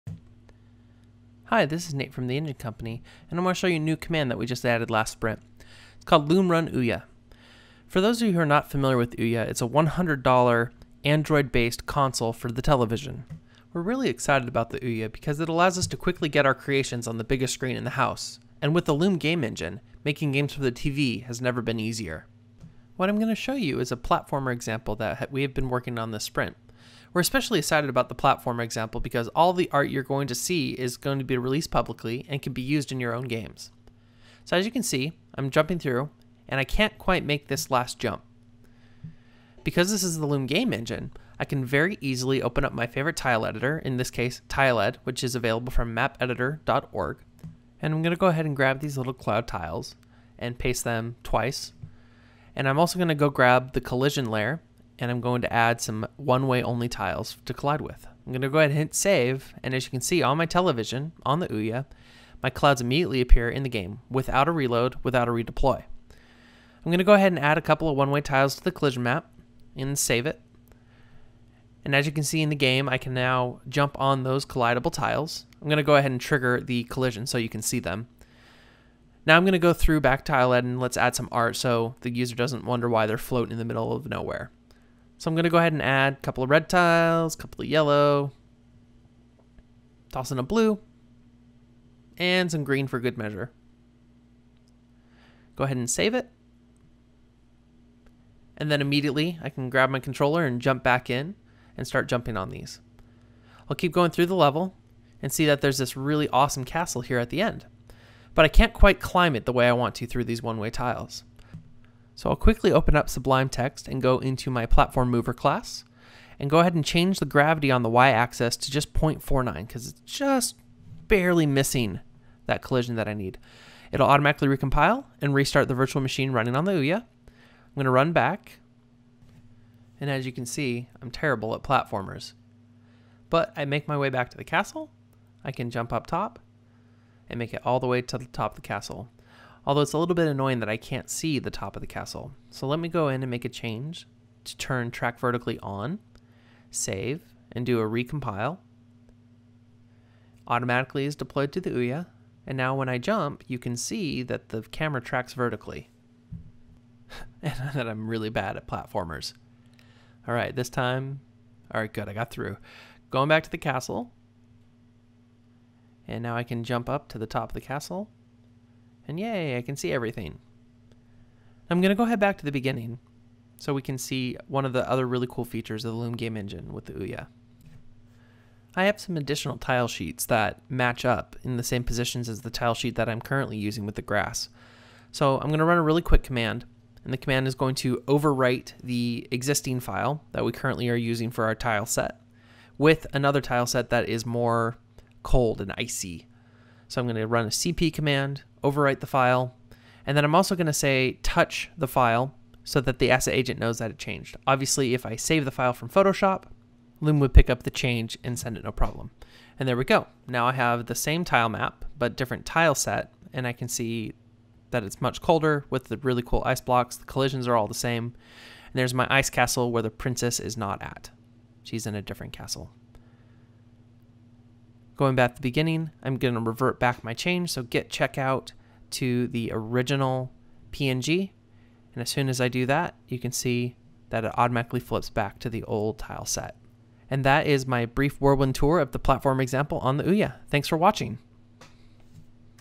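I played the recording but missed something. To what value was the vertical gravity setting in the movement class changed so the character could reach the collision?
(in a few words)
0.49.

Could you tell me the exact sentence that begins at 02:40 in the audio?
All right, this time, all right, good, I got through.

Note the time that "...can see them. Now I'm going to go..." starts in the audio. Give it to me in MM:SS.
01:17.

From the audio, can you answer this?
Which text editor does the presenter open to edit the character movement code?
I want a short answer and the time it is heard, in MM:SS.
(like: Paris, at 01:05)
Sublime Text, at 01:53.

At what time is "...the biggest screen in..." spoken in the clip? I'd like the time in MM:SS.
00:17.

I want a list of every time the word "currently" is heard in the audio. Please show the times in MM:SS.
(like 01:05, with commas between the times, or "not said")
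03:03, 03:10.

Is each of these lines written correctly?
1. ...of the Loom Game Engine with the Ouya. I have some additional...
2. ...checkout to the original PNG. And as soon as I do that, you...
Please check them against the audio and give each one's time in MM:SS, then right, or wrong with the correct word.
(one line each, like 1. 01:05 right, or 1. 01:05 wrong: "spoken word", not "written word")
1. 02:55 right
2. 03:47 right.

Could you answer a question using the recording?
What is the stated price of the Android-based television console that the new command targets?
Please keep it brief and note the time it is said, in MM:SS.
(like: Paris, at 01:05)
$100, at 00:09.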